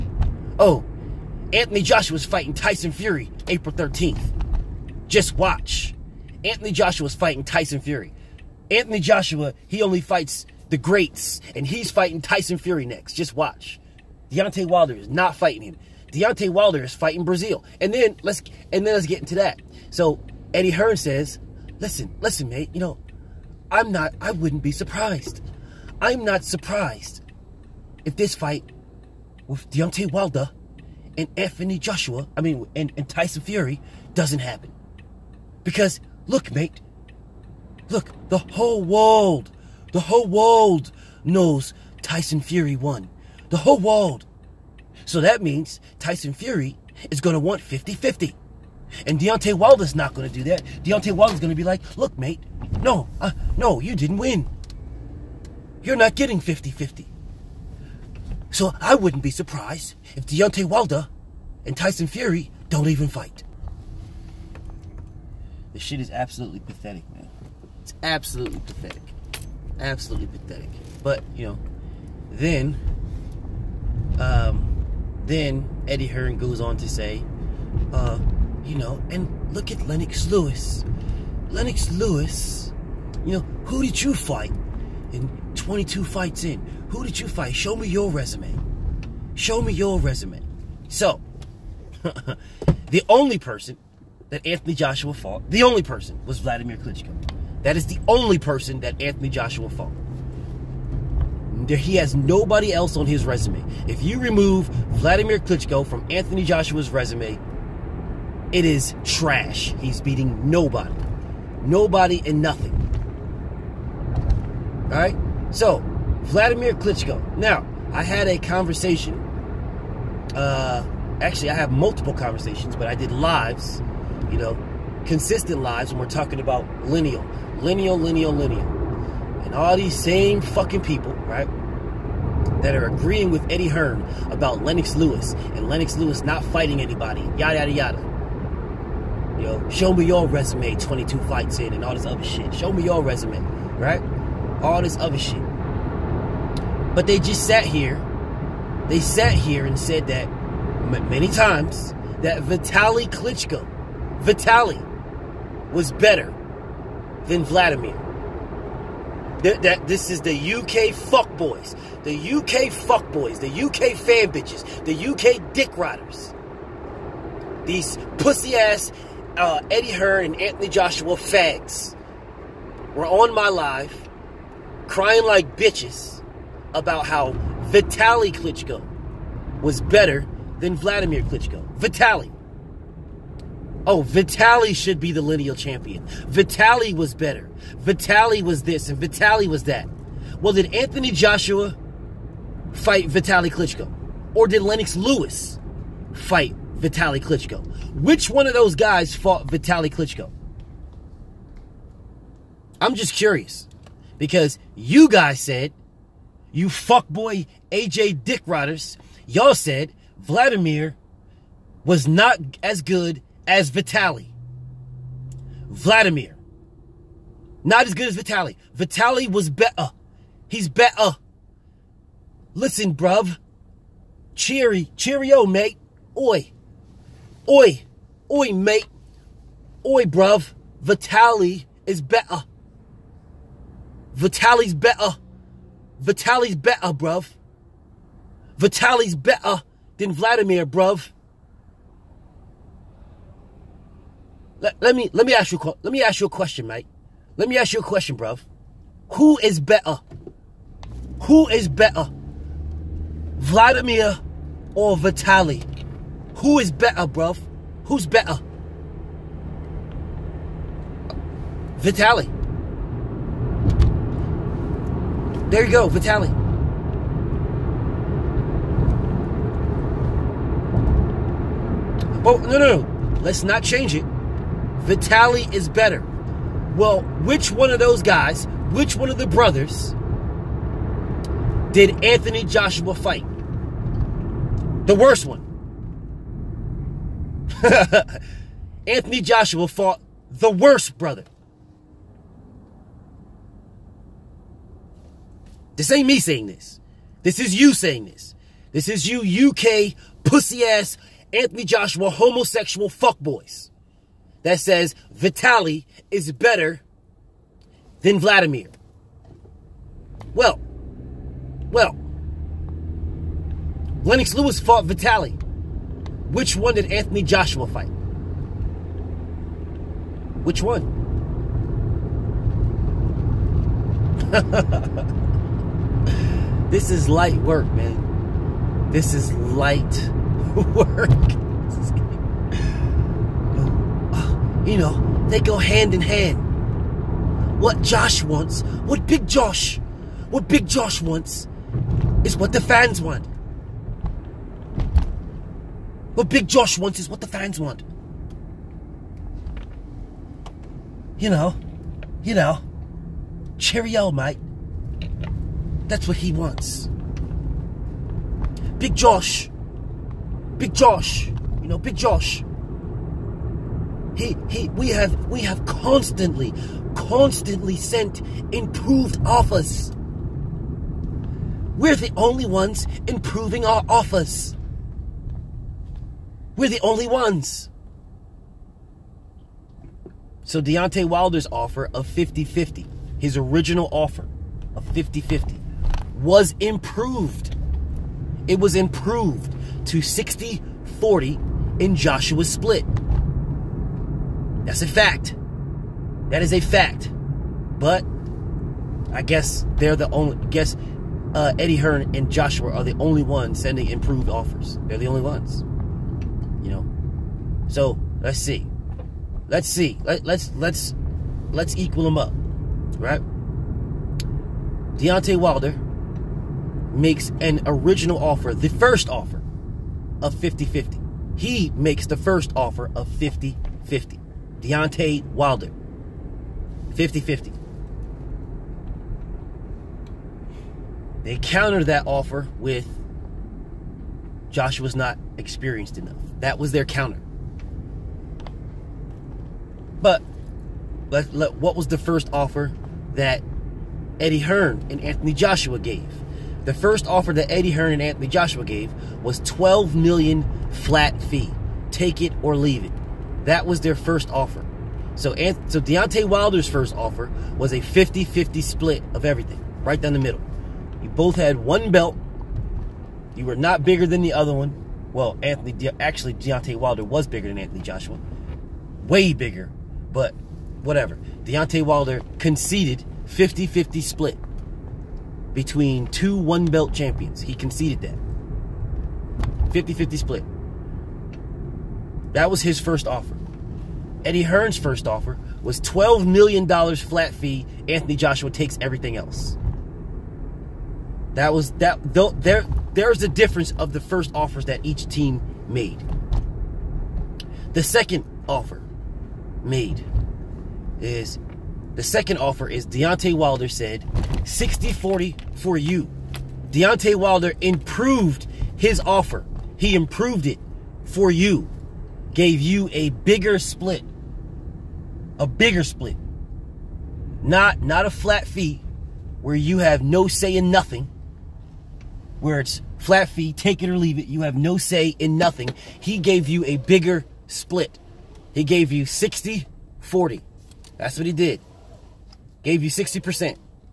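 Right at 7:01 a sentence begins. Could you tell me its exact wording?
He makes the first offer of 50 50.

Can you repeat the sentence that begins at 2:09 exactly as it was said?
And all these same fucking people, right?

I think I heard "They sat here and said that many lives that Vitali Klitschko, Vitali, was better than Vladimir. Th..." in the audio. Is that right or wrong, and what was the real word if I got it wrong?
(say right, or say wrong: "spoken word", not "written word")
wrong: "times", not "lives".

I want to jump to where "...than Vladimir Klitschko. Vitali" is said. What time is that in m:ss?
3:00.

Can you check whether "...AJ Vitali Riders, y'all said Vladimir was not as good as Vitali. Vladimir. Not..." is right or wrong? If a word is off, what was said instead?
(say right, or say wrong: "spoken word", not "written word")
wrong: "Dick", not "Vitali".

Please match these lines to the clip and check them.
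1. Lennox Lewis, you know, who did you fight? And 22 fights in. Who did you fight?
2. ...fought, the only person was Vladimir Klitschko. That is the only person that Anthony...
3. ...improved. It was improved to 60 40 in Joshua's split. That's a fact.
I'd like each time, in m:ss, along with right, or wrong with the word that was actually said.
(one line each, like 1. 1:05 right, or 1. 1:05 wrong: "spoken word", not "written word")
1. 1:21 right
2. 1:35 right
3. 6:26 right.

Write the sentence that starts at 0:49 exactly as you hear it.
And Deontay Wilder's not going to do that.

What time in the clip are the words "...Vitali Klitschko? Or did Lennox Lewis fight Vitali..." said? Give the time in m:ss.
3:13.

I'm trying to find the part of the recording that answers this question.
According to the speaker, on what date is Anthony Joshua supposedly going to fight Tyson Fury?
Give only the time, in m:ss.
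0:03.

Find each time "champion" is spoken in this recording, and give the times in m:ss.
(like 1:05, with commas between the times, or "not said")
3:05, 7:56.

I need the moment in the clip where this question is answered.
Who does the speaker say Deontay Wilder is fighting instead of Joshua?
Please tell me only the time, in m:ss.
0:17.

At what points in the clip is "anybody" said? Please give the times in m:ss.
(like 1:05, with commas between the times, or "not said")
2:16.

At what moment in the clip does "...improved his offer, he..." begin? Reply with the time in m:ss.
8:27.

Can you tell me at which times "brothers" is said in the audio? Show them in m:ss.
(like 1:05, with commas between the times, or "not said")
4:39, 4:50.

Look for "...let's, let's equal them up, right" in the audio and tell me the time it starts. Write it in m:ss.
6:50.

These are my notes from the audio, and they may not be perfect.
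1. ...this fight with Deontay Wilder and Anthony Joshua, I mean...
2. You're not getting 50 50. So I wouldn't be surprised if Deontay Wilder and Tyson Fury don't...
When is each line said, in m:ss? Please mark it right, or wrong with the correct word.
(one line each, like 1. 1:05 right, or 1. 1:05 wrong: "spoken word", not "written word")
1. 0:28 right
2. 0:55 right.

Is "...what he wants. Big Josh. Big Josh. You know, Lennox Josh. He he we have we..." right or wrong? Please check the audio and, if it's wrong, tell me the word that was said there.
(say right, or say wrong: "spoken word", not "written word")
wrong: "Big", not "Lennox".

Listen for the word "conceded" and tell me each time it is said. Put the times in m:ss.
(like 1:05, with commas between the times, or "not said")
7:52, 7:57.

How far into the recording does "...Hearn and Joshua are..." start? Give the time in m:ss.
6:41.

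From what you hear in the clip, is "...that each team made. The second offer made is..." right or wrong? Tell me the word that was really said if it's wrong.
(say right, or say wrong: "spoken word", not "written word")
right.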